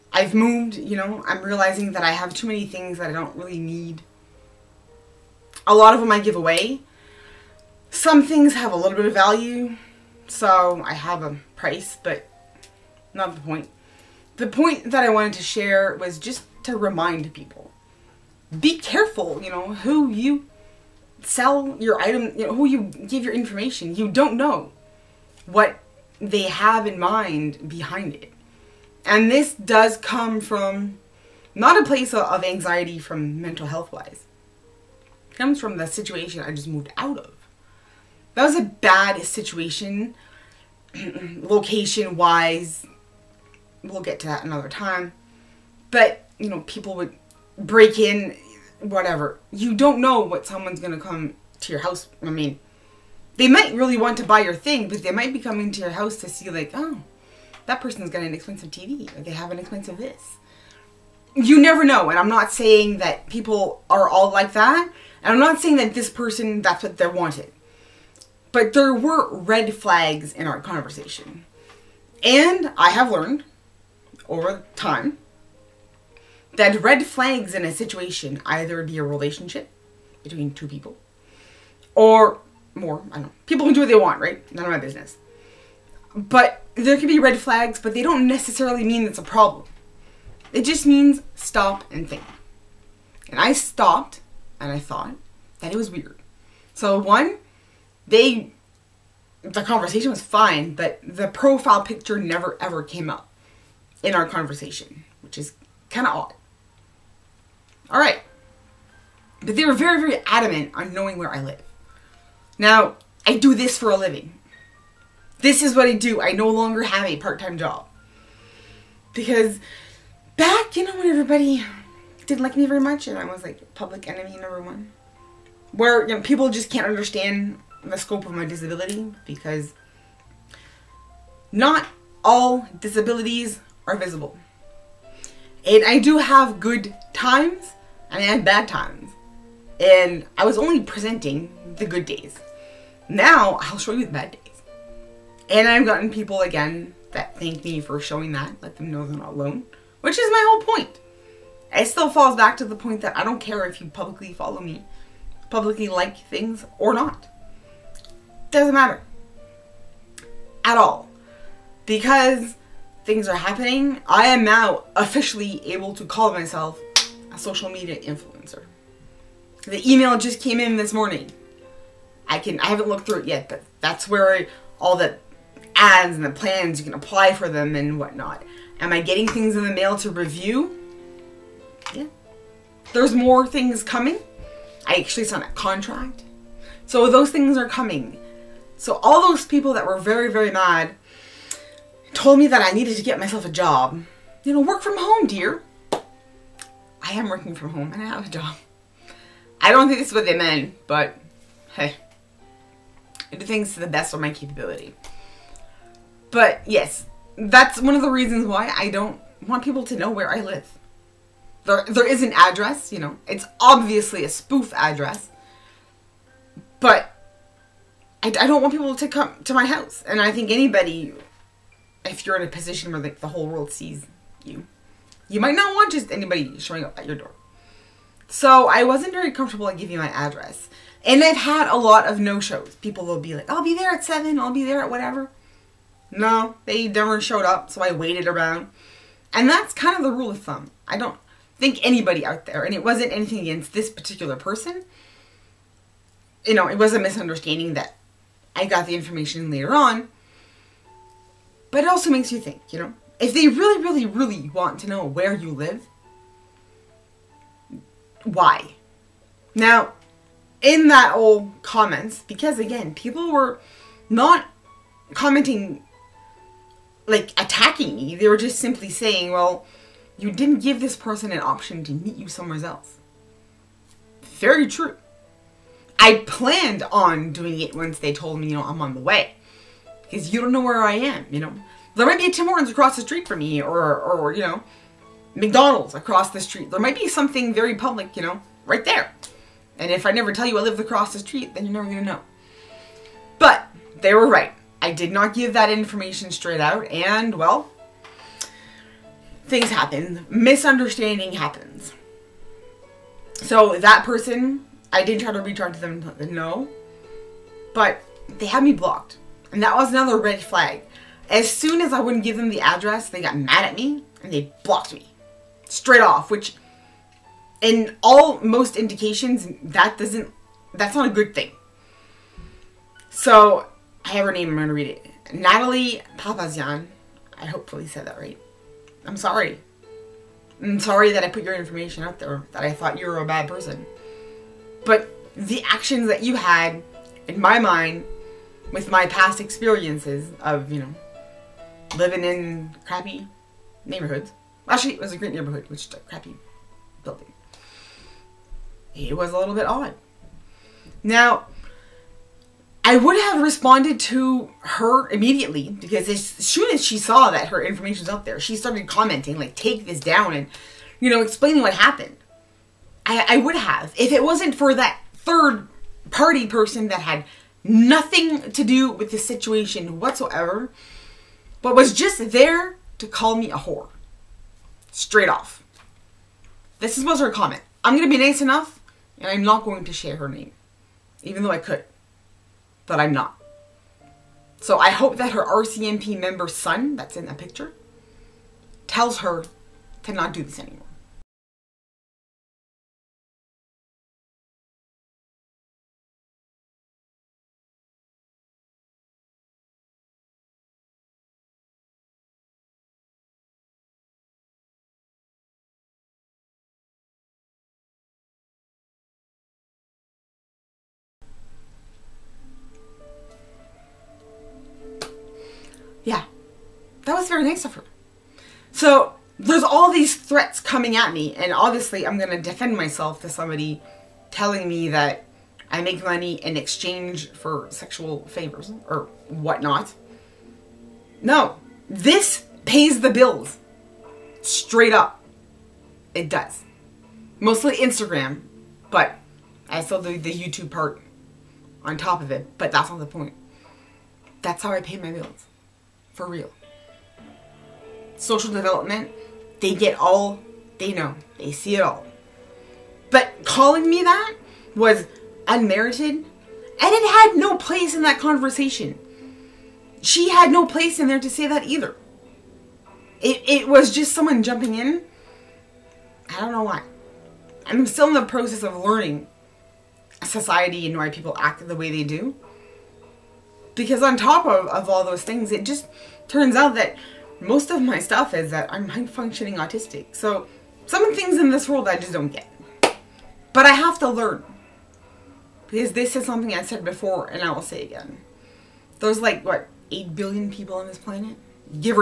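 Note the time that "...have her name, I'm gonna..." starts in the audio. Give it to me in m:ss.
5:24.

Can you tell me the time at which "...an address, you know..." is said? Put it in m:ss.
3:32.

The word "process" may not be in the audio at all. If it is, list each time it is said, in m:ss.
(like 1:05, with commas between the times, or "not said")
7:48.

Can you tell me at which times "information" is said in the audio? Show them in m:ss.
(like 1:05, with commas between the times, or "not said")
0:23, 4:08, 4:55, 5:31, 5:57.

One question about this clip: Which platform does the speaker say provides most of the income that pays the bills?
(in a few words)
Instagram.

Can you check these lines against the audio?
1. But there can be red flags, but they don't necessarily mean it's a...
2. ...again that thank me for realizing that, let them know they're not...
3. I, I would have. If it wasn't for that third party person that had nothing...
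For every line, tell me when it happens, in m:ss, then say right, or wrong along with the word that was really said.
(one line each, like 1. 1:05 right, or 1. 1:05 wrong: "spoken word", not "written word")
1. 1:26 right
2. 2:26 wrong: "showing", not "realizing"
3. 6:03 right.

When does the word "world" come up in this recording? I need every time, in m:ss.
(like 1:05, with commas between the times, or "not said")
3:43, 8:01.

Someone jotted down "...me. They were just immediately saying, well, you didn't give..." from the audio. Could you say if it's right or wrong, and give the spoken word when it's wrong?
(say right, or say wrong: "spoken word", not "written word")
wrong: "simply", not "immediately".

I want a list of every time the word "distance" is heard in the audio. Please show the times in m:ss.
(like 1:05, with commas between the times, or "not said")
not said.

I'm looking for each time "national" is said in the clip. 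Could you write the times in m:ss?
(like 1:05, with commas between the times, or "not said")
not said.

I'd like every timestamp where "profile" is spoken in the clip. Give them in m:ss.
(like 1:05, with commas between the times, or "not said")
1:41.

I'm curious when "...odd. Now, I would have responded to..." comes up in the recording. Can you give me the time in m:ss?
5:49.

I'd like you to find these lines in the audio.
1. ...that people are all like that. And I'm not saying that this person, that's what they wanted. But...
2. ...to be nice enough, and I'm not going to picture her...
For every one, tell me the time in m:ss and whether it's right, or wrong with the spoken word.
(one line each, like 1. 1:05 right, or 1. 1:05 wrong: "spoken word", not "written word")
1. 1:02 right
2. 6:18 wrong: "share", not "picture".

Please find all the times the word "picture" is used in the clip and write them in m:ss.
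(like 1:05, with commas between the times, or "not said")
1:41, 6:27.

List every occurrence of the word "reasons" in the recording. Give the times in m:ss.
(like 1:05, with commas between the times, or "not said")
3:28.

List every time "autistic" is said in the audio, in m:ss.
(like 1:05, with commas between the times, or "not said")
7:59.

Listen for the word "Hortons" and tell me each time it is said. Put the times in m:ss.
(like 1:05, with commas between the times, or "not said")
4:42.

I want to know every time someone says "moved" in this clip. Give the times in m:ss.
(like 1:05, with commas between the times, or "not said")
0:00, 0:36.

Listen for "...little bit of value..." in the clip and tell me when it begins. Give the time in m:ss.
0:08.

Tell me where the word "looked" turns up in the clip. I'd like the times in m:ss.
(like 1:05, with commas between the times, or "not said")
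2:52.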